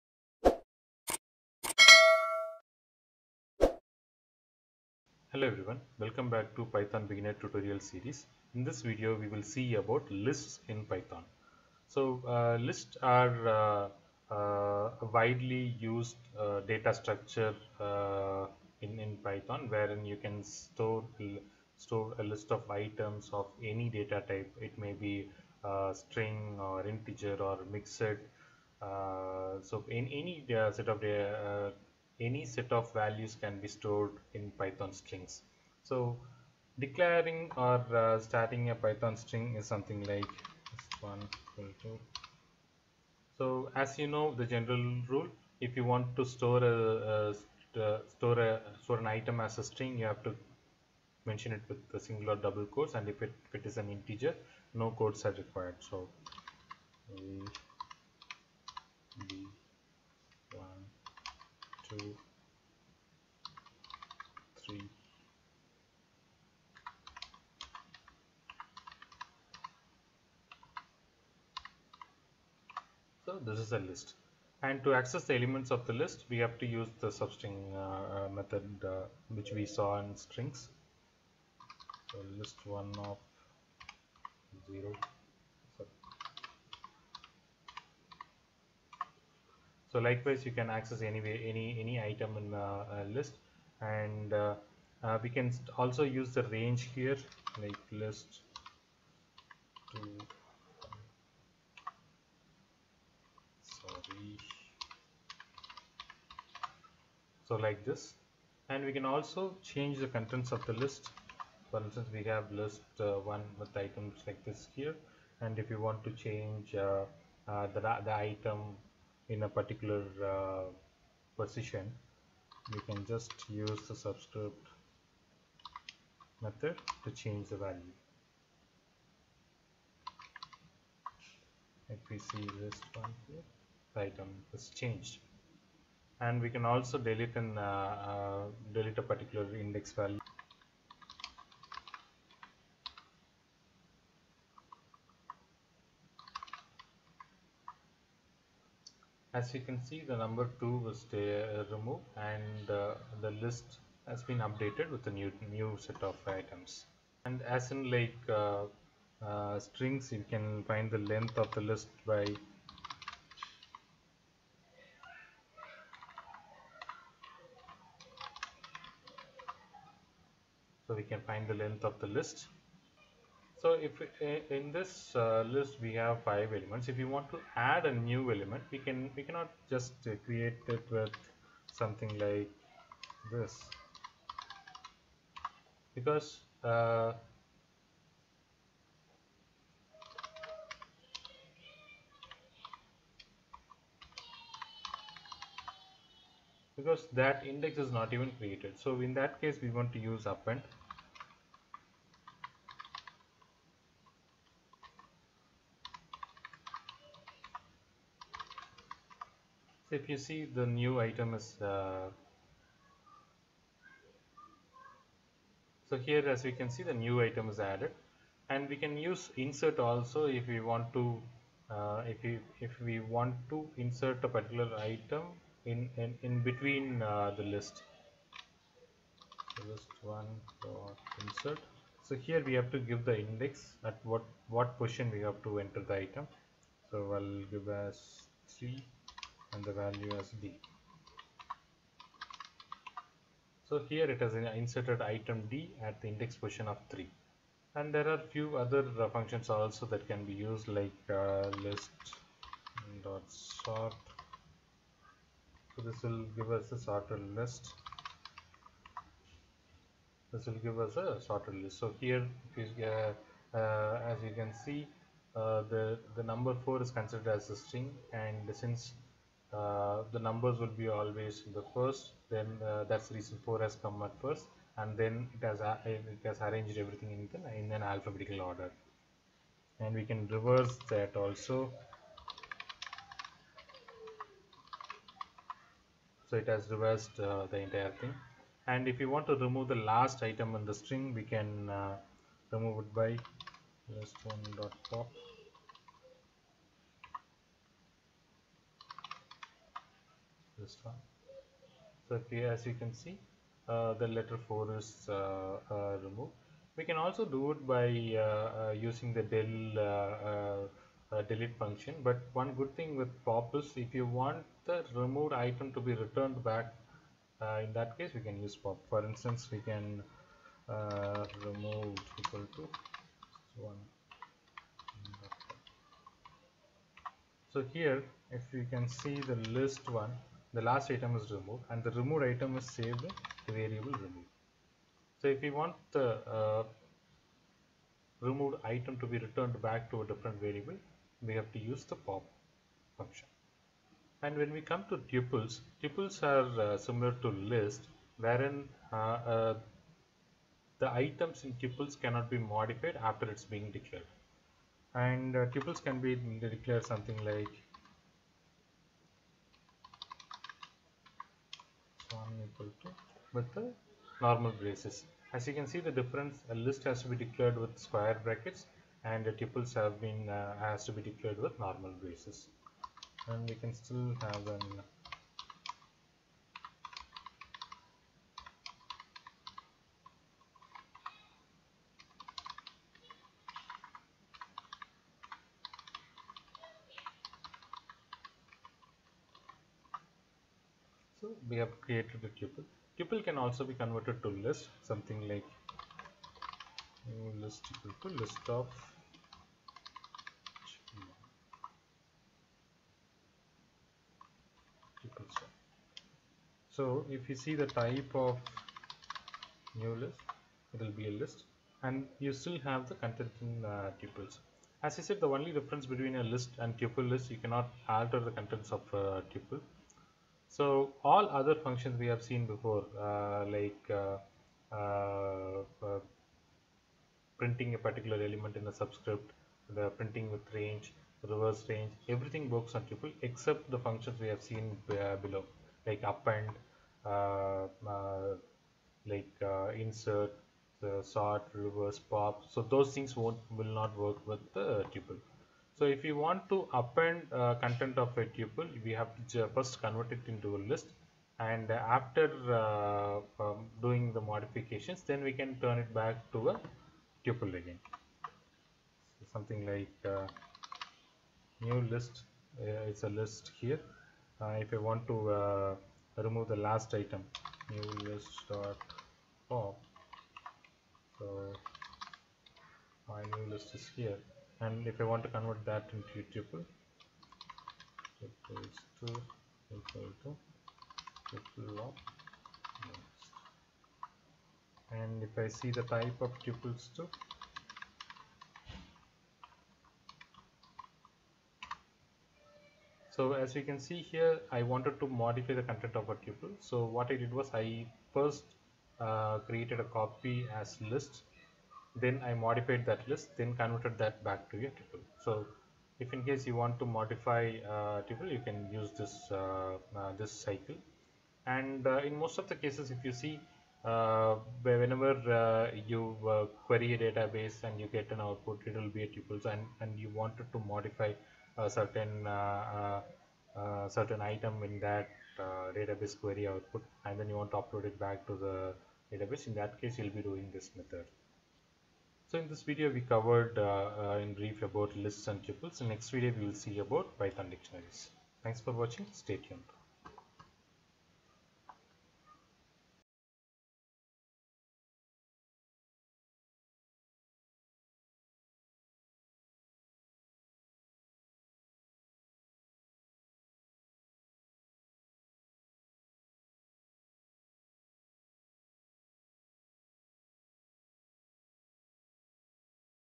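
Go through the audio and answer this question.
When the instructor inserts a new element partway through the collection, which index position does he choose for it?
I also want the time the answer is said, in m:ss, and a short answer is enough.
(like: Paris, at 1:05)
3, at 3:57.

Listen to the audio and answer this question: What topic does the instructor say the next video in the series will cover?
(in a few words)
Python dictionaries.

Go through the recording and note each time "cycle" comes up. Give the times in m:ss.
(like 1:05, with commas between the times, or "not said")
8:30.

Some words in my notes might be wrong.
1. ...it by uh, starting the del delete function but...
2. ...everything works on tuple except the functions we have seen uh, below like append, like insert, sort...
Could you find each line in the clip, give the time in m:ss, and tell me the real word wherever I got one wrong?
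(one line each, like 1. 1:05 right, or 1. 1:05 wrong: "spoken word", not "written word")
1. 5:07 wrong: "using", not "starting"
2. 7:12 right.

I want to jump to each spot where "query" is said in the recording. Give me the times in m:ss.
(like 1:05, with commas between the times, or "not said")
8:36, 8:46.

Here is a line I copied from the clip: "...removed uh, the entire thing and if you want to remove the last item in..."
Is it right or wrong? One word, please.
wrong.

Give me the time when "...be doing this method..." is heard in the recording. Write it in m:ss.
8:50.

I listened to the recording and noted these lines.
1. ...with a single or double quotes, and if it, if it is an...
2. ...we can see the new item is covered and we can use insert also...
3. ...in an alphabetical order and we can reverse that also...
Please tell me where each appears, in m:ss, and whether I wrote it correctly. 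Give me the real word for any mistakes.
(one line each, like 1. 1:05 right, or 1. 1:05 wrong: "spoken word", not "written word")
1. 0:51 right
2. 3:36 wrong: "added", not "covered"
3. 4:37 right.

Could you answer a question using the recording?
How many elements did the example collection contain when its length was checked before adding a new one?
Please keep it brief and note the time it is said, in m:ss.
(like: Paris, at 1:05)
5, at 2:56.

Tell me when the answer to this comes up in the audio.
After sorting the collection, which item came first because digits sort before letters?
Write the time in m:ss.
4:33.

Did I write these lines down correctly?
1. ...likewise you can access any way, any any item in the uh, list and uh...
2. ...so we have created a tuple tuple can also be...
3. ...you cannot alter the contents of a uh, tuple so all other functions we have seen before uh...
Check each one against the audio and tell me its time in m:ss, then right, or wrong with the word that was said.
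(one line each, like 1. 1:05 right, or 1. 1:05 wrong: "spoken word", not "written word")
1. 1:29 right
2. 6:31 right
3. 6:57 right.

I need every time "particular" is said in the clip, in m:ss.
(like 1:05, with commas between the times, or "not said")
1:59, 2:19, 3:44, 7:07.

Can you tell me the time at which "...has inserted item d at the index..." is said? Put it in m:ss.
4:04.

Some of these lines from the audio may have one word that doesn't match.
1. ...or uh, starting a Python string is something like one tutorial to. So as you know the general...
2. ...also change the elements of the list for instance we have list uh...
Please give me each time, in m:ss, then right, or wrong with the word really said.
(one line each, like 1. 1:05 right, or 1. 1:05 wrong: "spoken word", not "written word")
1. 0:37 wrong: "equal", not "tutorial"
2. 1:49 wrong: "contents", not "elements".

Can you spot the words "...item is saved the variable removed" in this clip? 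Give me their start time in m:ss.
5:32.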